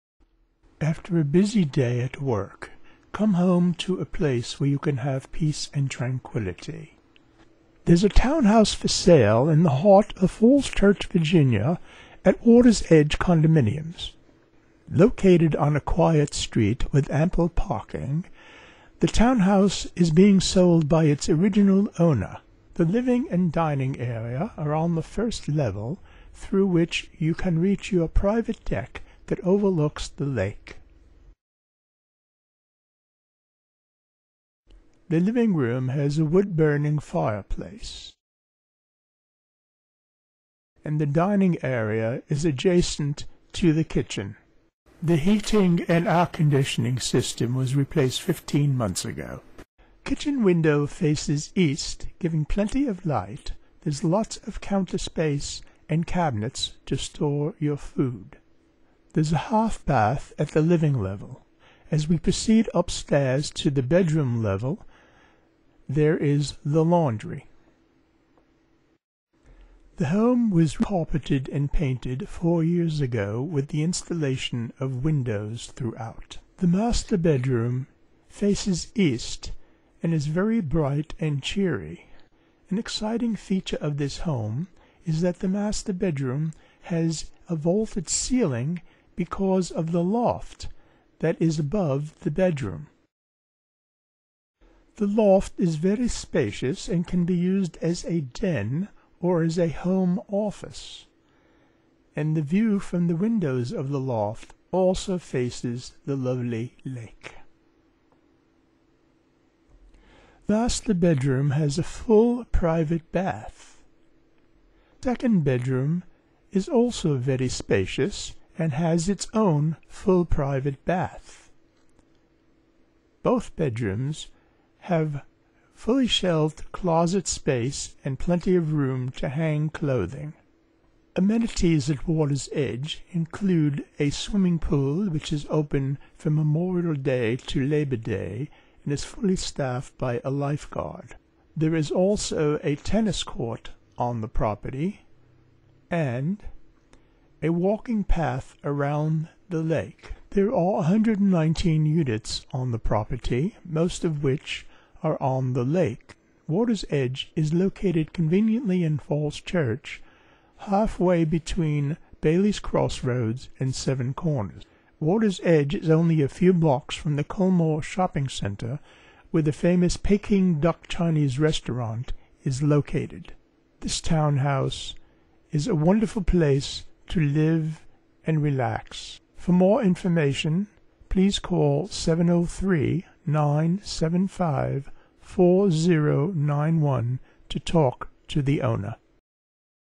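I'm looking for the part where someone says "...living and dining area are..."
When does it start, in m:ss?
0:22.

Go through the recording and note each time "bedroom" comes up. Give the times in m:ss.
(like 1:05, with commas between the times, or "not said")
1:03, 1:17, 1:25, 1:32, 1:50, 1:55, 2:03.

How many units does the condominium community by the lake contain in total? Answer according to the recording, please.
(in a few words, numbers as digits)
119.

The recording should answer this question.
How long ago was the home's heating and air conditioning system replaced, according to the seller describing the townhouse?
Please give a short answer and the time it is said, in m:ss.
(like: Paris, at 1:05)
15 months, at 0:48.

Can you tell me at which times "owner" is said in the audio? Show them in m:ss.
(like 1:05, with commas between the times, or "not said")
0:21, 3:08.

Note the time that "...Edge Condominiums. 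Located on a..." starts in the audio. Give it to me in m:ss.
0:12.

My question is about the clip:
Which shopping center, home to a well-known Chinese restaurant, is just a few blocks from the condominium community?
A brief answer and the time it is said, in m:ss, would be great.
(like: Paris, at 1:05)
Culmore Shopping Center, at 2:47.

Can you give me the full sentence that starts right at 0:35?
The living room has a wood-burning fireplace.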